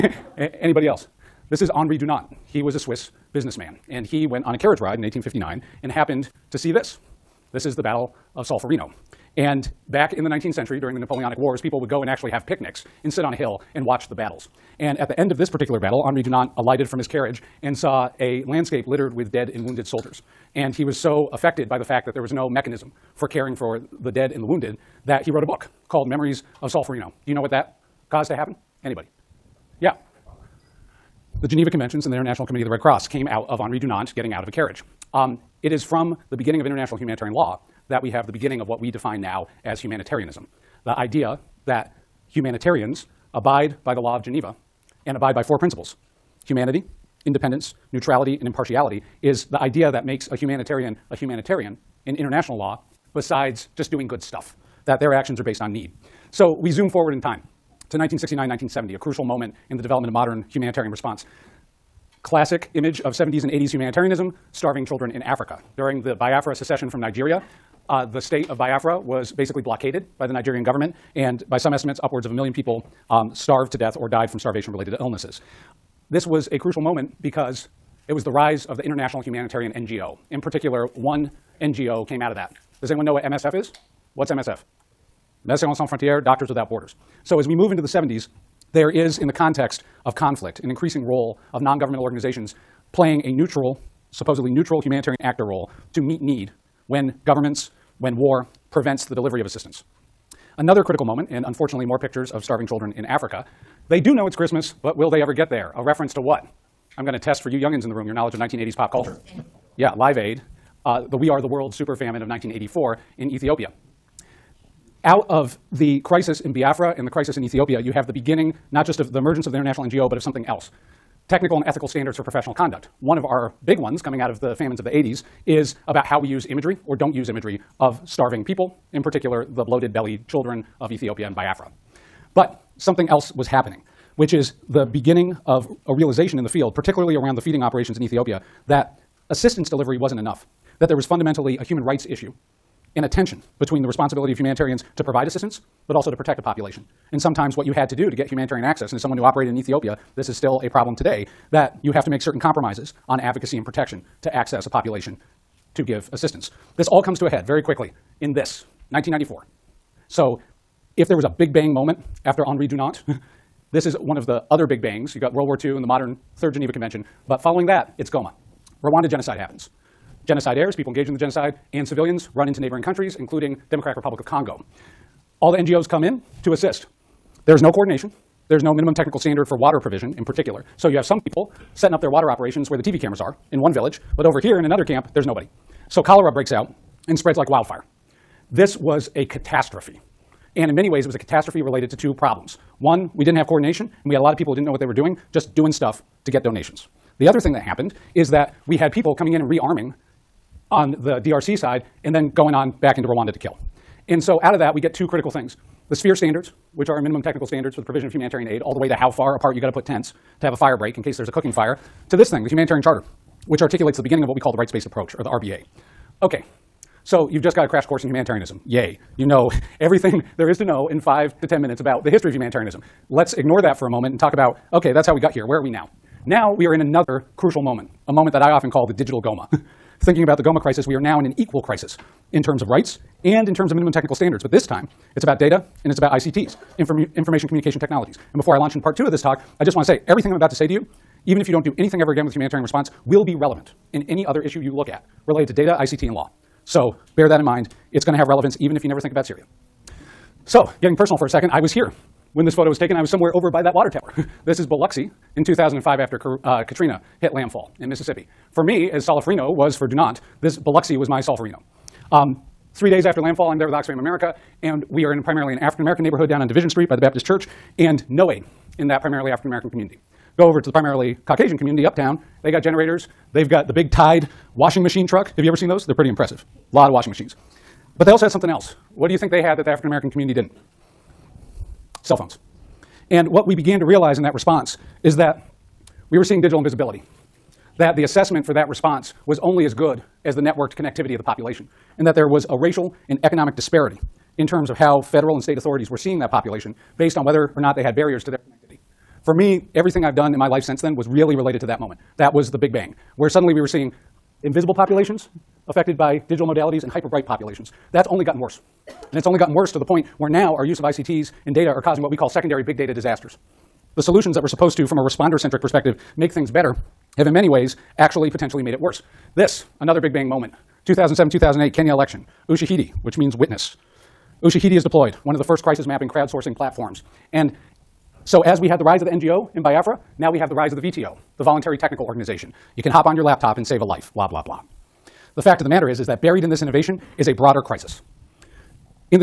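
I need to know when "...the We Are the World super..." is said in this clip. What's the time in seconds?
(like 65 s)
111 s.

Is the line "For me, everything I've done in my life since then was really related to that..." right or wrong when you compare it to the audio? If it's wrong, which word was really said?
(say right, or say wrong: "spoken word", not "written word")
right.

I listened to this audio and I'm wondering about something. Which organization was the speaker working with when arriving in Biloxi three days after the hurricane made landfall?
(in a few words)
Oxfam America.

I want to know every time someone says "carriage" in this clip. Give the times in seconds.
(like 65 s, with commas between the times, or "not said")
4 s, 17 s, 34 s.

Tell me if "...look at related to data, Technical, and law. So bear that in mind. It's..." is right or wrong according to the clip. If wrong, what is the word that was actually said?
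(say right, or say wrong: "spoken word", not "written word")
wrong: "ICT", not "Technical".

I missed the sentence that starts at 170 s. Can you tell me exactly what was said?
Genocide heirs, people engaged in the genocide, and civilians run into neighboring countries, including Democratic Republic of Congo.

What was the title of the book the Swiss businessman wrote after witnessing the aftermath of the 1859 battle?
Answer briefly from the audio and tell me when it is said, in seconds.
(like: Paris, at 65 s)
Memories of Solferino, at 26 s.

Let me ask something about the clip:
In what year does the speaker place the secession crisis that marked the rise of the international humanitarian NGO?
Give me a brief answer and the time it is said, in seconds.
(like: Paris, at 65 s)
1969, at 57 s.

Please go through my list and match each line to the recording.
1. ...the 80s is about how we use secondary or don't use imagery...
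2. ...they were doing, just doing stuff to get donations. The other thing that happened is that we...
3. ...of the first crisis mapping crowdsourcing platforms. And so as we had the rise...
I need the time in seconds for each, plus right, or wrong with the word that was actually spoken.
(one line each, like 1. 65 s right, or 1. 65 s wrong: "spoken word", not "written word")
1. 124 s wrong: "imagery", not "secondary"
2. 194 s right
3. 325 s right.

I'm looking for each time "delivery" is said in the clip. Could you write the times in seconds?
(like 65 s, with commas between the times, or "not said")
99 s, 139 s.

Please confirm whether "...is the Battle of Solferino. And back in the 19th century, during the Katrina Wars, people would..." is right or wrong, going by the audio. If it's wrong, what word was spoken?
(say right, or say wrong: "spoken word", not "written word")
wrong: "Napoleonic", not "Katrina".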